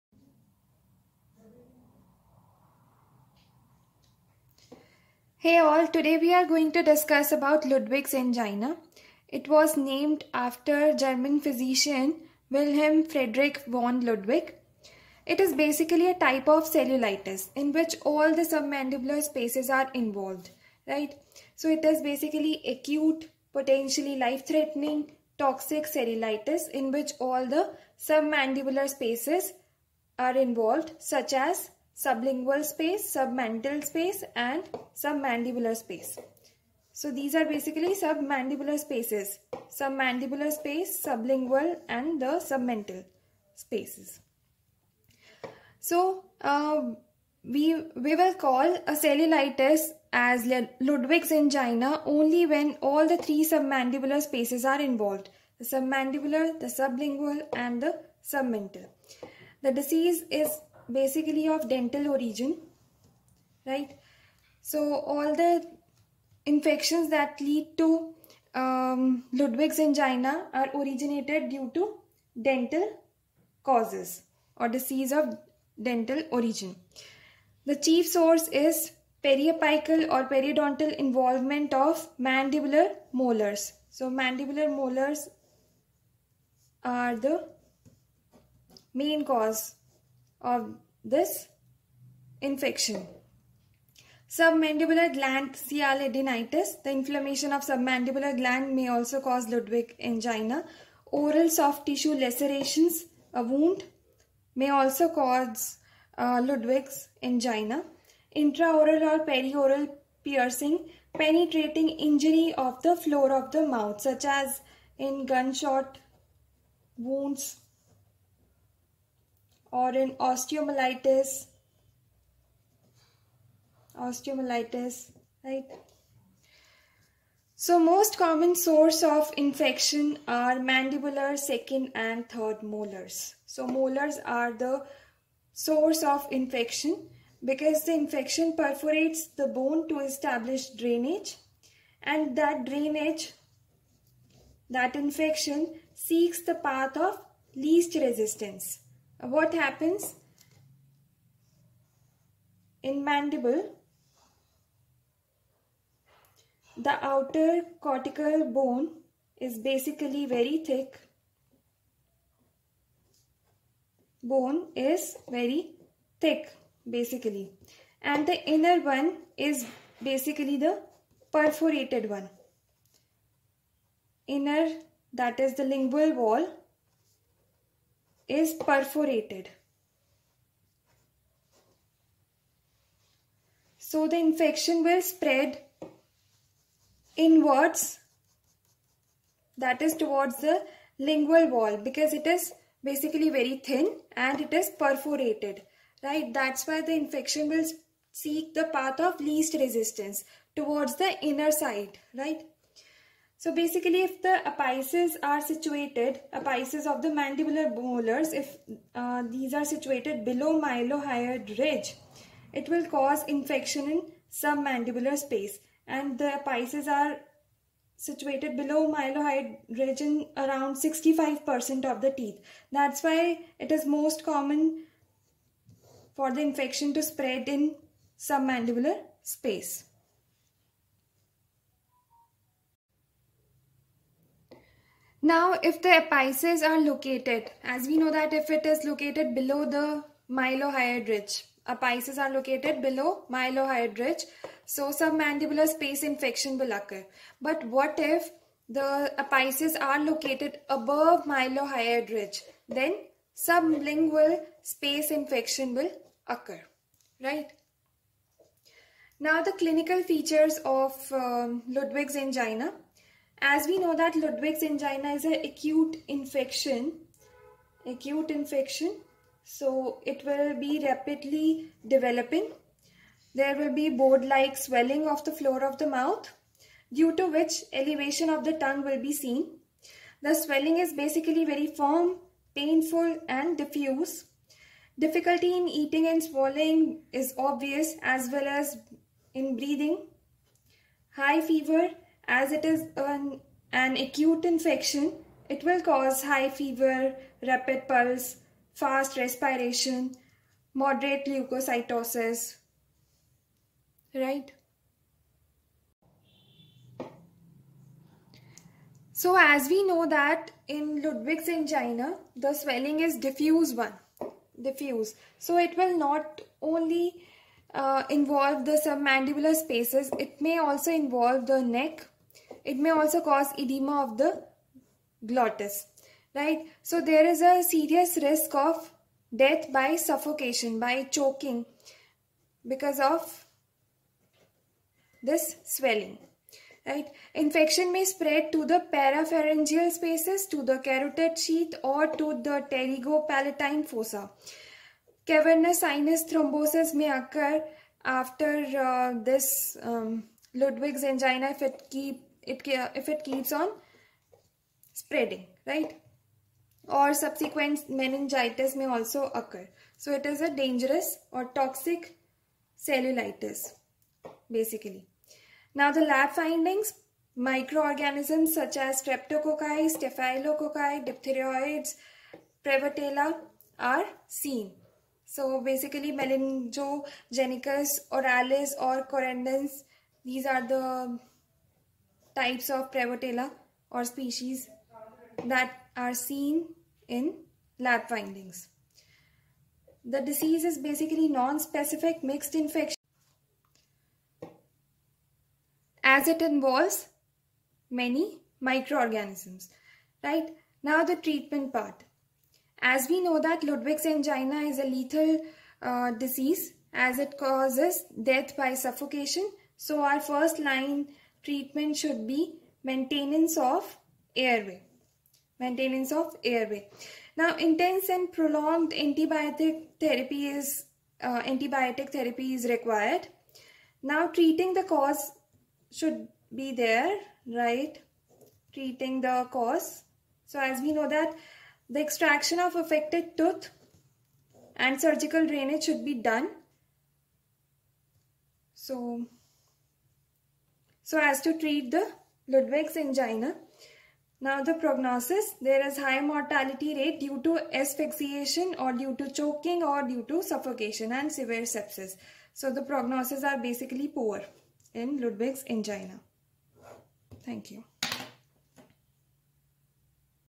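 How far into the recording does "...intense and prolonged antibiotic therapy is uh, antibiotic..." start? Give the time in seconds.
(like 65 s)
417 s.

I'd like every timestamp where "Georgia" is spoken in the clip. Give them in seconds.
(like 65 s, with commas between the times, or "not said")
not said.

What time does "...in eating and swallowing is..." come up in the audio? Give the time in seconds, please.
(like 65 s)
285 s.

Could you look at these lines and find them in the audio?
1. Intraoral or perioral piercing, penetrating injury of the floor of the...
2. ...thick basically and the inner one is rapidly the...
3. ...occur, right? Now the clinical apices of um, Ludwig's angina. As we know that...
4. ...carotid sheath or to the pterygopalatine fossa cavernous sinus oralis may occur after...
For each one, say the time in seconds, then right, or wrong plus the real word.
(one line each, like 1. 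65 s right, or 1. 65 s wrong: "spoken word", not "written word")
1. 108 s right
2. 166 s wrong: "basically", not "rapidly"
3. 256 s wrong: "features", not "apices"
4. 340 s wrong: "thrombosis", not "oralis".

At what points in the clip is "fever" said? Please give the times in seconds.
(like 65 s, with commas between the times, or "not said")
291 s, 296 s.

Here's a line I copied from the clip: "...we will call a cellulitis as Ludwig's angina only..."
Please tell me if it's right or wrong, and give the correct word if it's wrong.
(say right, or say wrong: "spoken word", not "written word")
right.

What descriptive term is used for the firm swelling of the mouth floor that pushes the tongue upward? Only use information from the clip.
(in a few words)
board-like.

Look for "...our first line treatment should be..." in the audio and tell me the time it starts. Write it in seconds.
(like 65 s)
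410 s.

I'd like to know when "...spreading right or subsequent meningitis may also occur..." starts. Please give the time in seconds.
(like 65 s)
354 s.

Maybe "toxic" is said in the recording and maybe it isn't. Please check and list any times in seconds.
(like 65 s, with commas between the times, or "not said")
25 s, 361 s.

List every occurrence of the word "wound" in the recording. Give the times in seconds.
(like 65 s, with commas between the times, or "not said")
103 s, 116 s.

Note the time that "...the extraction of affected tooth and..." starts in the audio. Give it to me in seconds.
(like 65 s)
431 s.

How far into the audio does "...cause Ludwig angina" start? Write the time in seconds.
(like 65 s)
99 s.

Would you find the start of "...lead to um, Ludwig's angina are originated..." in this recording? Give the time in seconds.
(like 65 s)
67 s.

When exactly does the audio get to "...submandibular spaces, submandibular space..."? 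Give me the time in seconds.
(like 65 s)
37 s.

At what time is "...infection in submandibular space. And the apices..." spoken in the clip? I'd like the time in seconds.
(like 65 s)
213 s.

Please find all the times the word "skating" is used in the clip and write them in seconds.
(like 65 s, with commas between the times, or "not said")
not said.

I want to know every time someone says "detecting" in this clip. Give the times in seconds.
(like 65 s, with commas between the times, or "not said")
not said.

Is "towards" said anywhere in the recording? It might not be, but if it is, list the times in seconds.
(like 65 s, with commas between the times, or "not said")
189 s, 200 s.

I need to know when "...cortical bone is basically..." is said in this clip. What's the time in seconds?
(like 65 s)
157 s.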